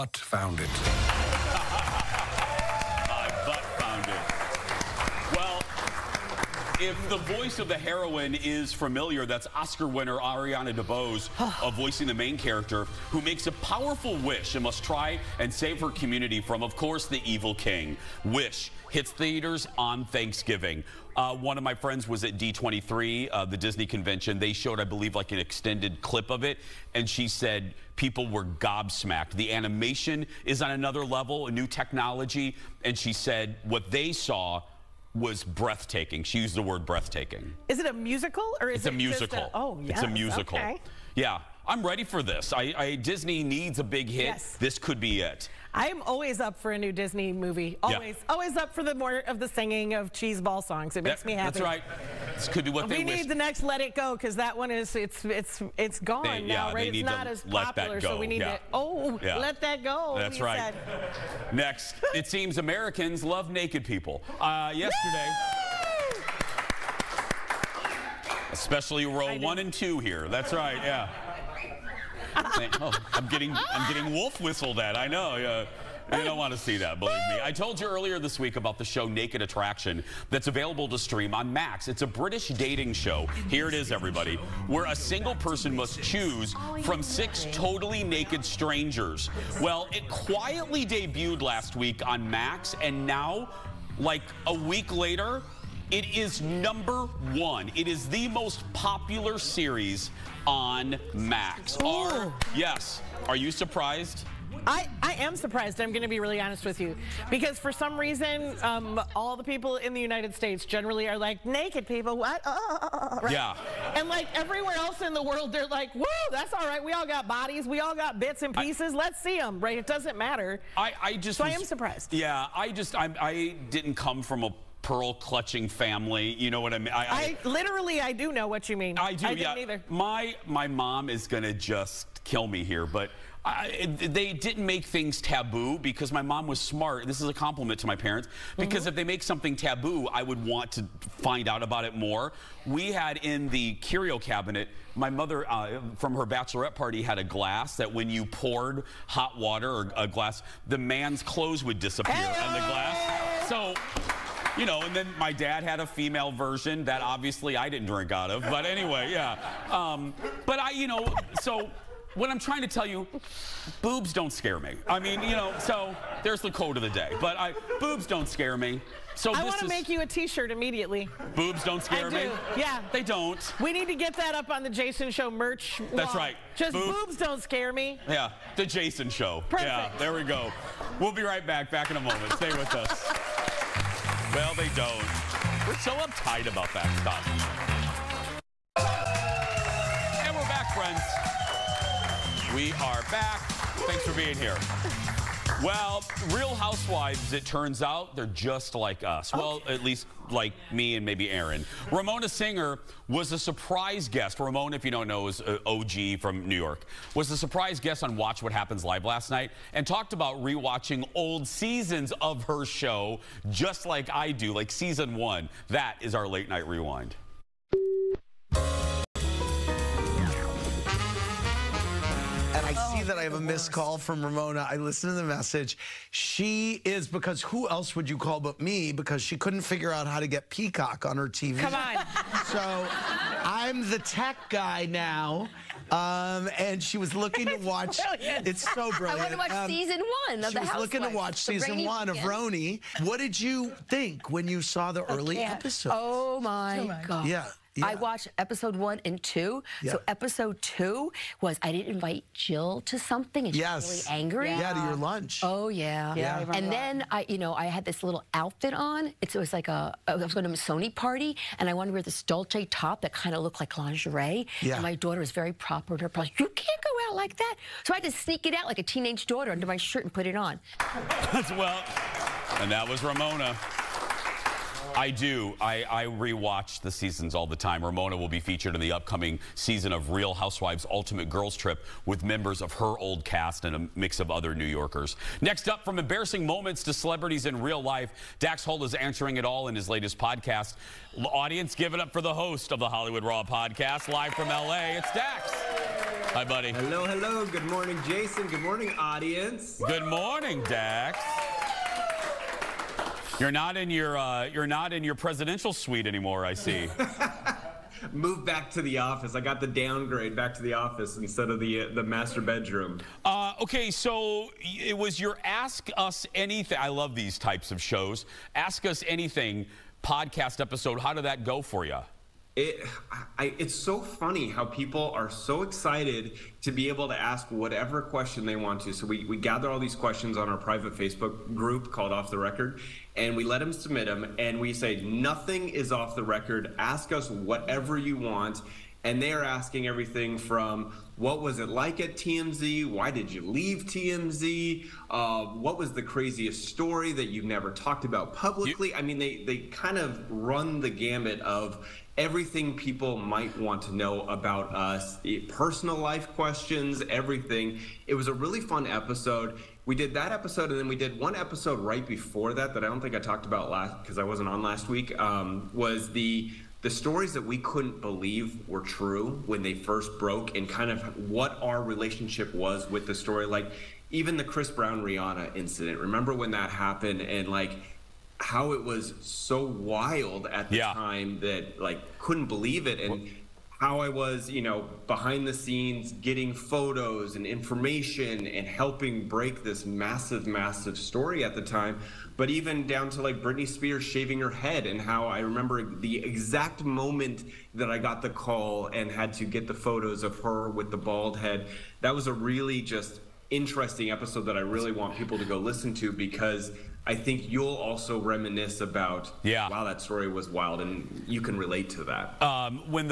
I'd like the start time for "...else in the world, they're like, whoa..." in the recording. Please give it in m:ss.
1:54.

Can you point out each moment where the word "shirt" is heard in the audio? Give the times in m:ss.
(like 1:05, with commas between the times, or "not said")
2:50, 4:29.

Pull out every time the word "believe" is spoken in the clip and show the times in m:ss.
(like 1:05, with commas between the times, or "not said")
0:24, 1:17, 6:08, 6:22.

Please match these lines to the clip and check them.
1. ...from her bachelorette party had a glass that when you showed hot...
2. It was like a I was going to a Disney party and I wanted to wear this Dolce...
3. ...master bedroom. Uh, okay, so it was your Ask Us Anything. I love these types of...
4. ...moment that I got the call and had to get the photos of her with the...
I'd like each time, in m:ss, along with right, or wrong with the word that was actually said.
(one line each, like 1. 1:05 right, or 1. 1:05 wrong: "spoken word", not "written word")
1. 2:25 wrong: "poured", not "showed"
2. 4:19 wrong: "Sony", not "Disney"
3. 5:12 right
4. 6:36 right.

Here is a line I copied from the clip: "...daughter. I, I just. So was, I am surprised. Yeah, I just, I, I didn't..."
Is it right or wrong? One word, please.
wrong.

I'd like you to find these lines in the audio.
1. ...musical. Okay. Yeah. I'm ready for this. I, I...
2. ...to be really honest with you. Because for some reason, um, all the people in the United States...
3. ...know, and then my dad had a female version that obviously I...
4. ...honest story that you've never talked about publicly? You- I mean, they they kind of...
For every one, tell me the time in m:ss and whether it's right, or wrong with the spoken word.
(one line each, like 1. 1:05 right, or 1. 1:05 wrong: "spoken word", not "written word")
1. 0:40 right
2. 1:46 right
3. 2:34 right
4. 5:46 wrong: "craziest", not "honest".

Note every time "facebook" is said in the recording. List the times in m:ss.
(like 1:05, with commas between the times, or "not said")
5:30.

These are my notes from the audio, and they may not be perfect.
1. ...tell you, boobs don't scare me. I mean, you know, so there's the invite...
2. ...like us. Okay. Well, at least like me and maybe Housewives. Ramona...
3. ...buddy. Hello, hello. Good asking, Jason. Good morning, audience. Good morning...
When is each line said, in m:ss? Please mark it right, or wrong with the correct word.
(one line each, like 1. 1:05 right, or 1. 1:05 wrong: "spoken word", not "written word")
1. 2:42 wrong: "quote", not "invite"
2. 3:18 wrong: "Erin", not "Housewives"
3. 4:56 wrong: "morning", not "asking".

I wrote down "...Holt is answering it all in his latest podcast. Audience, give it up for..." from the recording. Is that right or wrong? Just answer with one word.
right.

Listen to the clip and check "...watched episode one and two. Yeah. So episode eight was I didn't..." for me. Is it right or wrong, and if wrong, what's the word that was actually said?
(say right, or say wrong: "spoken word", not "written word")
wrong: "two", not "eight".